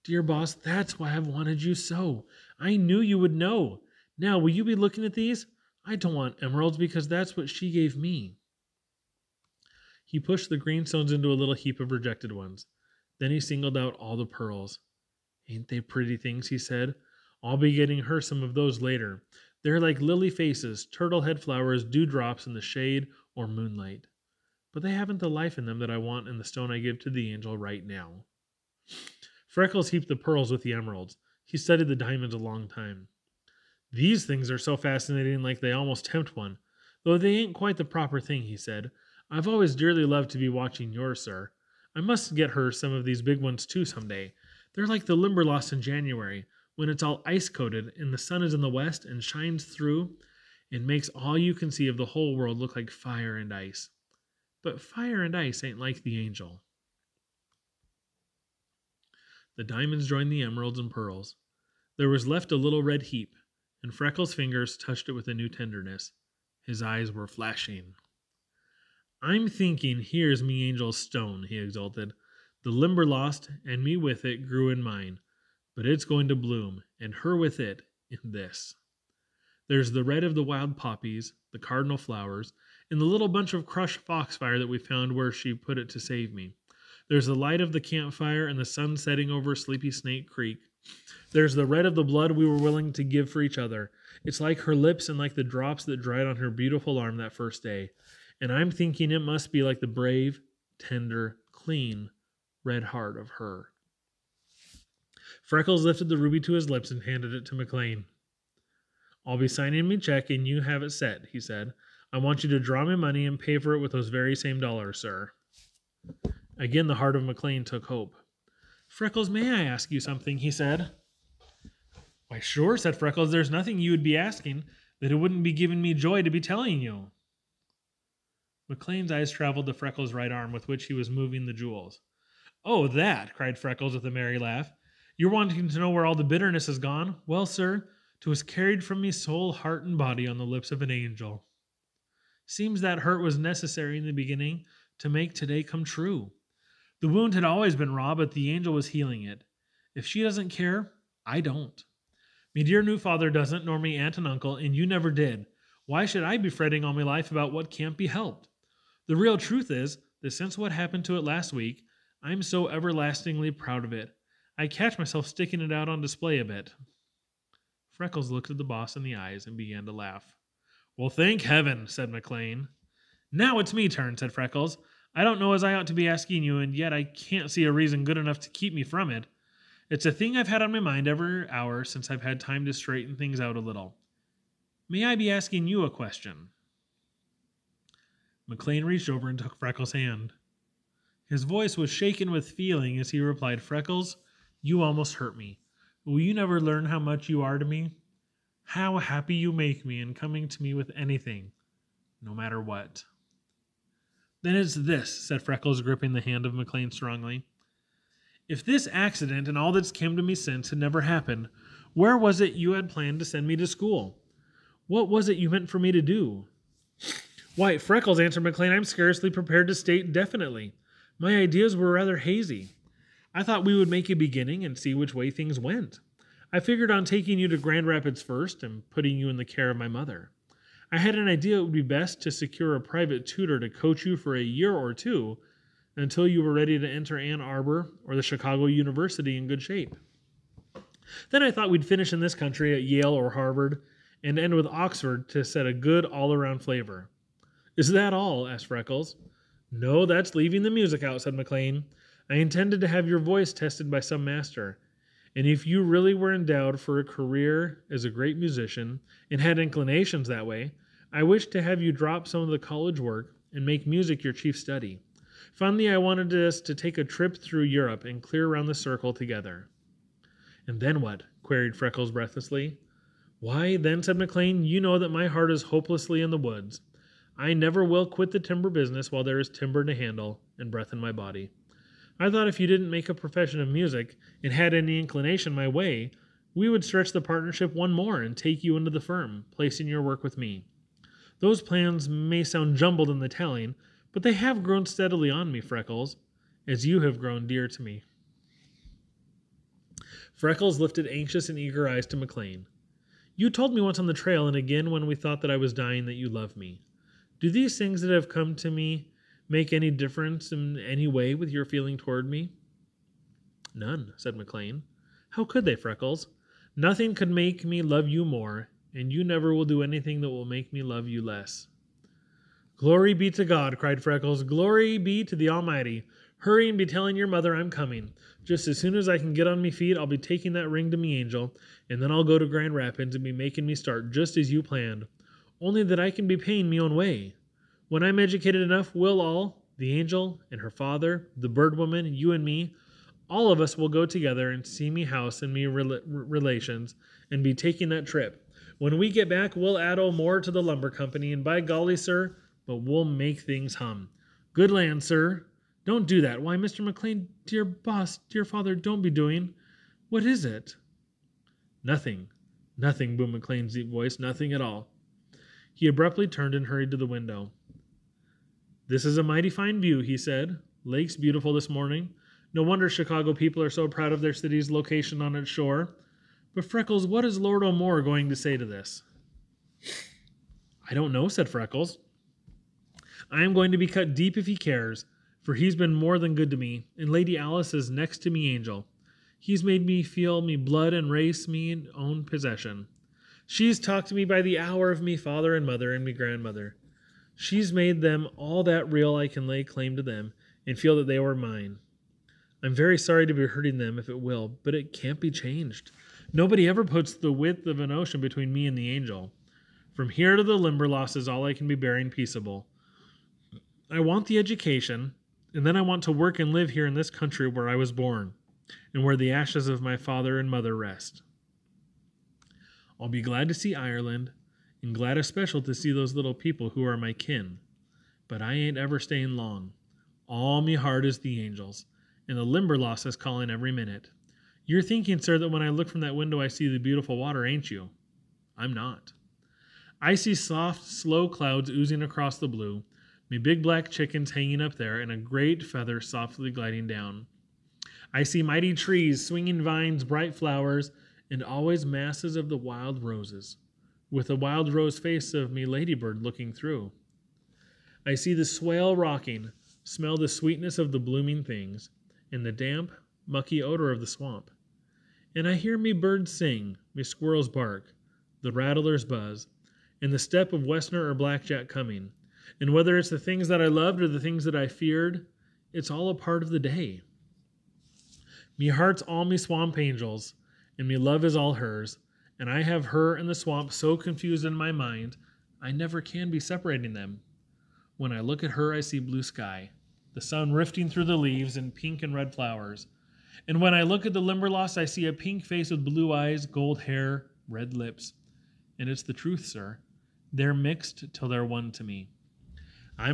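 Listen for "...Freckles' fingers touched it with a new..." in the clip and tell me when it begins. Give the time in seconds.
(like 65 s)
63 s.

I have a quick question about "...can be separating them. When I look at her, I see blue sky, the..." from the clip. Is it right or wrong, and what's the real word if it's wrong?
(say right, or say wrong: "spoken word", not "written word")
right.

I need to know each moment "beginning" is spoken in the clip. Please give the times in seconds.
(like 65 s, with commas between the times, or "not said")
144 s, 224 s.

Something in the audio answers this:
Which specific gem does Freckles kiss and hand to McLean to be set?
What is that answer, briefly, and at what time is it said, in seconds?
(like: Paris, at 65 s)
Ruby, at 106 s.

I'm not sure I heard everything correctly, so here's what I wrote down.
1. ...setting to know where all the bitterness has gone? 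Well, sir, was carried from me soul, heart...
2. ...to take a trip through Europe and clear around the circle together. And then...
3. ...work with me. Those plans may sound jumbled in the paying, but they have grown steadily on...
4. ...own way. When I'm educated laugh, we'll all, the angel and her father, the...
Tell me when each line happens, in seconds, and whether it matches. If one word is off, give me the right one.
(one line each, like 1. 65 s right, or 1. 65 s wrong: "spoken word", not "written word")
1. 135 s wrong: "wanting", not "setting"
2. 266 s right
3. 290 s wrong: "telling", not "paying"
4. 336 s wrong: "enough", not "laugh".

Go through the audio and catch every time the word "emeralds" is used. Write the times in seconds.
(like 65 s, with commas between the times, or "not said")
6 s, 30 s, 60 s.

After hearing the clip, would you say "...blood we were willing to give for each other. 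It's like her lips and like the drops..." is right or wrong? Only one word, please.
right.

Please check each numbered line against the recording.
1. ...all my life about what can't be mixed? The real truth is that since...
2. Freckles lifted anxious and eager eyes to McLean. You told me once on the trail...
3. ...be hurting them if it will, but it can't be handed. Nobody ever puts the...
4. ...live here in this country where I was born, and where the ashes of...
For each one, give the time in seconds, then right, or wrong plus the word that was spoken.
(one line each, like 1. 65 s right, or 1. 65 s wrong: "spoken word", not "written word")
1. 156 s wrong: "helped", not "mixed"
2. 300 s right
3. 403 s wrong: "changed", not "handed"
4. 416 s right.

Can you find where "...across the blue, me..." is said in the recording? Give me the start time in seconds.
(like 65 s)
442 s.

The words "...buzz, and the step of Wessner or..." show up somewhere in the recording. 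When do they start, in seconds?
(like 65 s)
469 s.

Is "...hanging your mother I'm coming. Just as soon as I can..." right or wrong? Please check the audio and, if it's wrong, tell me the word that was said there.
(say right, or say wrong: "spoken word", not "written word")
wrong: "telling", not "hanging".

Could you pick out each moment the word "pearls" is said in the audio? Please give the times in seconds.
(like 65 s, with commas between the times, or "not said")
14 s, 30 s, 60 s.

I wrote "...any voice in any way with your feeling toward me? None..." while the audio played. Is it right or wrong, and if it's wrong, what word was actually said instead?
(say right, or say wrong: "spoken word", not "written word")
wrong: "difference", not "voice".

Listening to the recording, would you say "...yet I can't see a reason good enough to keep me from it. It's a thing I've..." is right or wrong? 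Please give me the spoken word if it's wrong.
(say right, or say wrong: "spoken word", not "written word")
right.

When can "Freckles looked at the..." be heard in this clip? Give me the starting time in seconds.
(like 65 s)
168 s.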